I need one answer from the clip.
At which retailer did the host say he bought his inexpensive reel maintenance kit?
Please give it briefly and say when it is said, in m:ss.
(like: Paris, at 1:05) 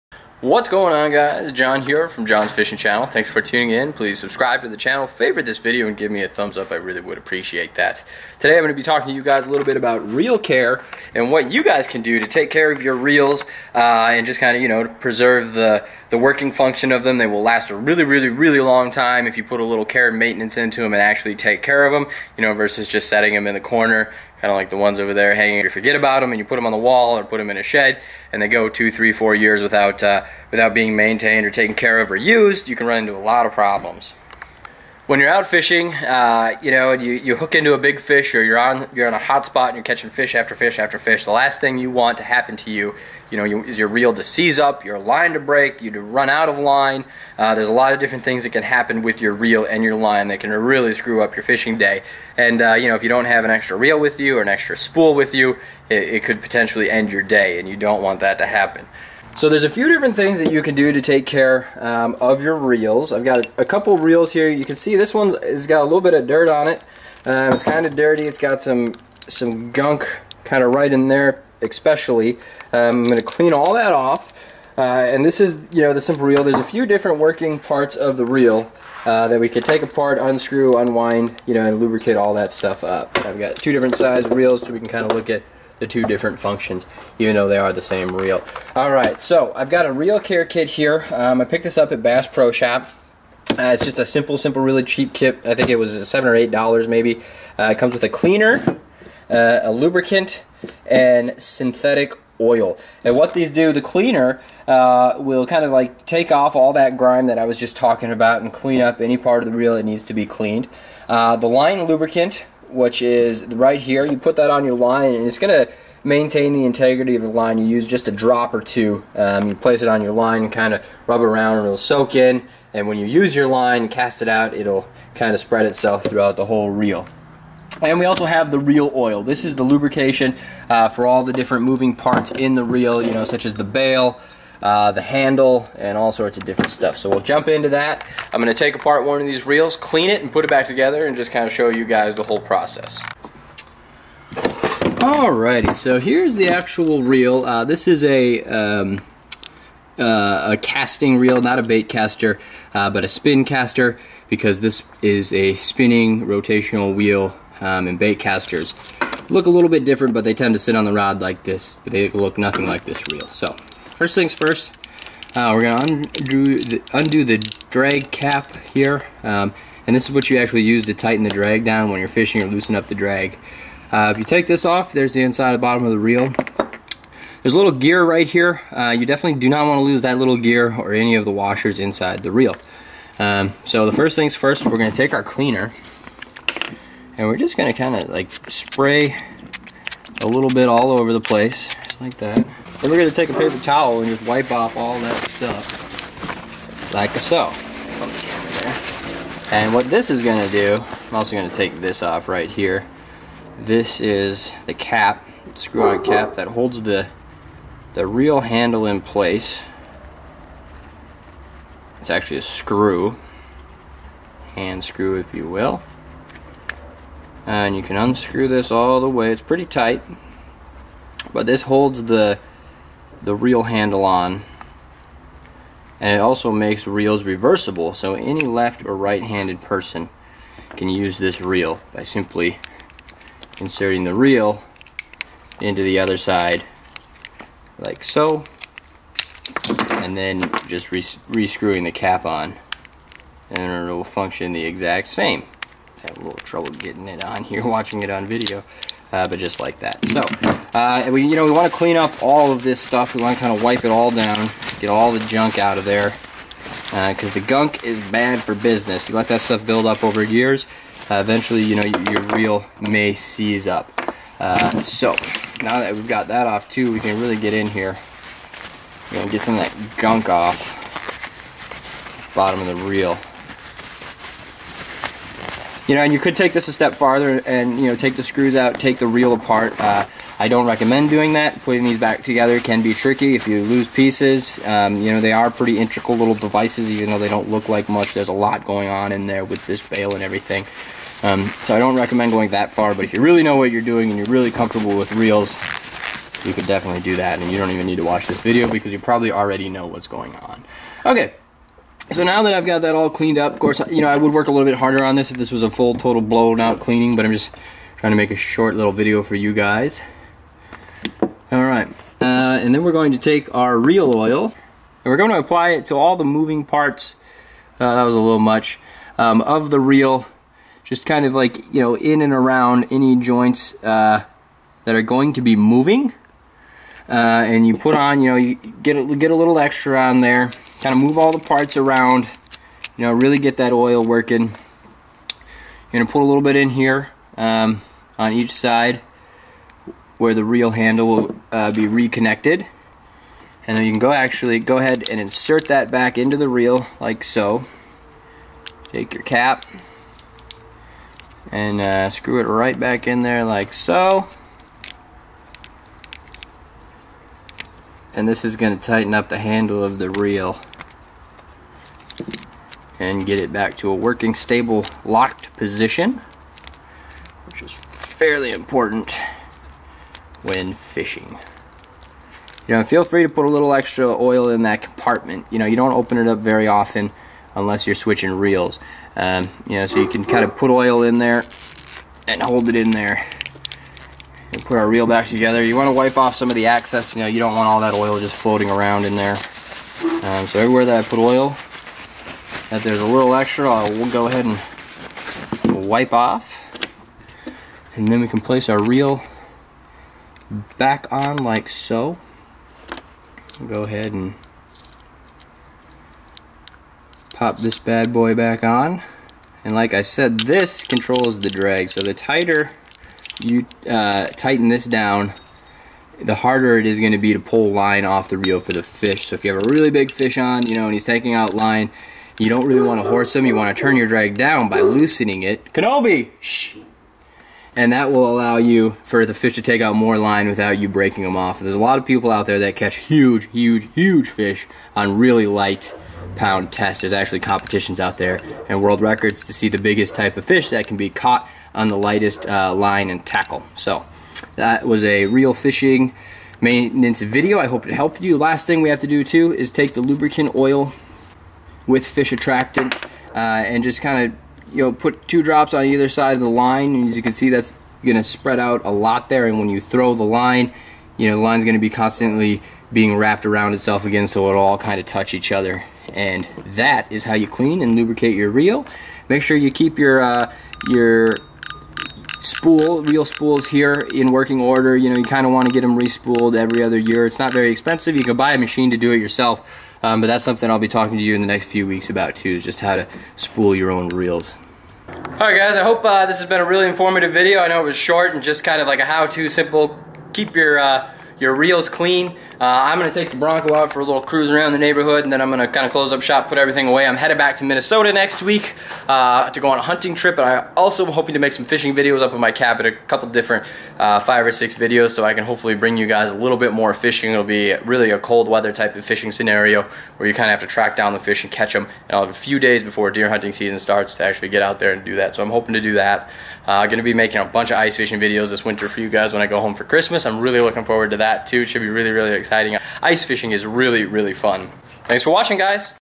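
Bass Pro Shop, at 1:32.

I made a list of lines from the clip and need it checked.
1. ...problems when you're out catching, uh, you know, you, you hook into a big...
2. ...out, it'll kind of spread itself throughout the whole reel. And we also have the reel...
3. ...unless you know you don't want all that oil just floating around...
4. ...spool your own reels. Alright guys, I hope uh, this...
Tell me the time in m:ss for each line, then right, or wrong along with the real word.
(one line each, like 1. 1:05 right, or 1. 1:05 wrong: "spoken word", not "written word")
1. 0:33 wrong: "fishing", not "catching"
2. 2:04 right
3. 6:26 wrong: "excess", not "unless"
4. 8:03 right.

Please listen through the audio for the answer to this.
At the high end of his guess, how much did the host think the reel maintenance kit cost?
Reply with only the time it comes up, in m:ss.
1:36.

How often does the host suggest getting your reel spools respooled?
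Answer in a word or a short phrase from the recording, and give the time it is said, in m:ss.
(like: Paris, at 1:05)
every other year, at 7:56.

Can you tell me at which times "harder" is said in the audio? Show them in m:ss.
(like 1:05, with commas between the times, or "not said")
5:04, 6:56.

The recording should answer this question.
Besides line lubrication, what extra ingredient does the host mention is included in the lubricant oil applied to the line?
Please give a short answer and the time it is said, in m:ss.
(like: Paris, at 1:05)
fish attractant, at 7:32.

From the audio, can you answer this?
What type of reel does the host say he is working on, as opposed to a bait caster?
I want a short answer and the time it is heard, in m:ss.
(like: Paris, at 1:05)
spin caster, at 2:33.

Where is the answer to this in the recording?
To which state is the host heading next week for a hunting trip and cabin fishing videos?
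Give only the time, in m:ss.
8:17.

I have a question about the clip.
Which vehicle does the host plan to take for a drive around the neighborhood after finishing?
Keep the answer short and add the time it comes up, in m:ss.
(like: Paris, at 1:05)
the Bronco, at 8:13.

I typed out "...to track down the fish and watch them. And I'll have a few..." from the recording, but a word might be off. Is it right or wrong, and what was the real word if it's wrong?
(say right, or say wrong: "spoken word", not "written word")
wrong: "catch", not "watch".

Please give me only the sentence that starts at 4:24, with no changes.
Uh, so, now that we've got that off too, we can really get in here.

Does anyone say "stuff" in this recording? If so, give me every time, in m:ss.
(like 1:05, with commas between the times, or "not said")
1:22, 2:16, 3:15, 4:12, 4:19.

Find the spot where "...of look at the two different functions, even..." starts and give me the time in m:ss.
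1:25.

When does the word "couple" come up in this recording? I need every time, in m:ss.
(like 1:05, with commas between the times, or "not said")
1:03, 8:22.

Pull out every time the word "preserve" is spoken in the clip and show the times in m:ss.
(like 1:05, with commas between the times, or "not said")
0:14.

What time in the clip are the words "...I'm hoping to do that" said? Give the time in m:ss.
8:35.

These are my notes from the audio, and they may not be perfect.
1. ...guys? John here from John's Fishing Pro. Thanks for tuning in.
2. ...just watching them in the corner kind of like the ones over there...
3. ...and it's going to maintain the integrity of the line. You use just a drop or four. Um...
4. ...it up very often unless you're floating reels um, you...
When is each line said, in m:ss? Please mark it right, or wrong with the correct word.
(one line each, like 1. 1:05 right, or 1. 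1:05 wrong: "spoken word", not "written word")
1. 0:01 wrong: "Channel", not "Pro"
2. 0:22 wrong: "setting", not "watching"
3. 1:55 wrong: "two", not "four"
4. 6:16 wrong: "switching", not "floating".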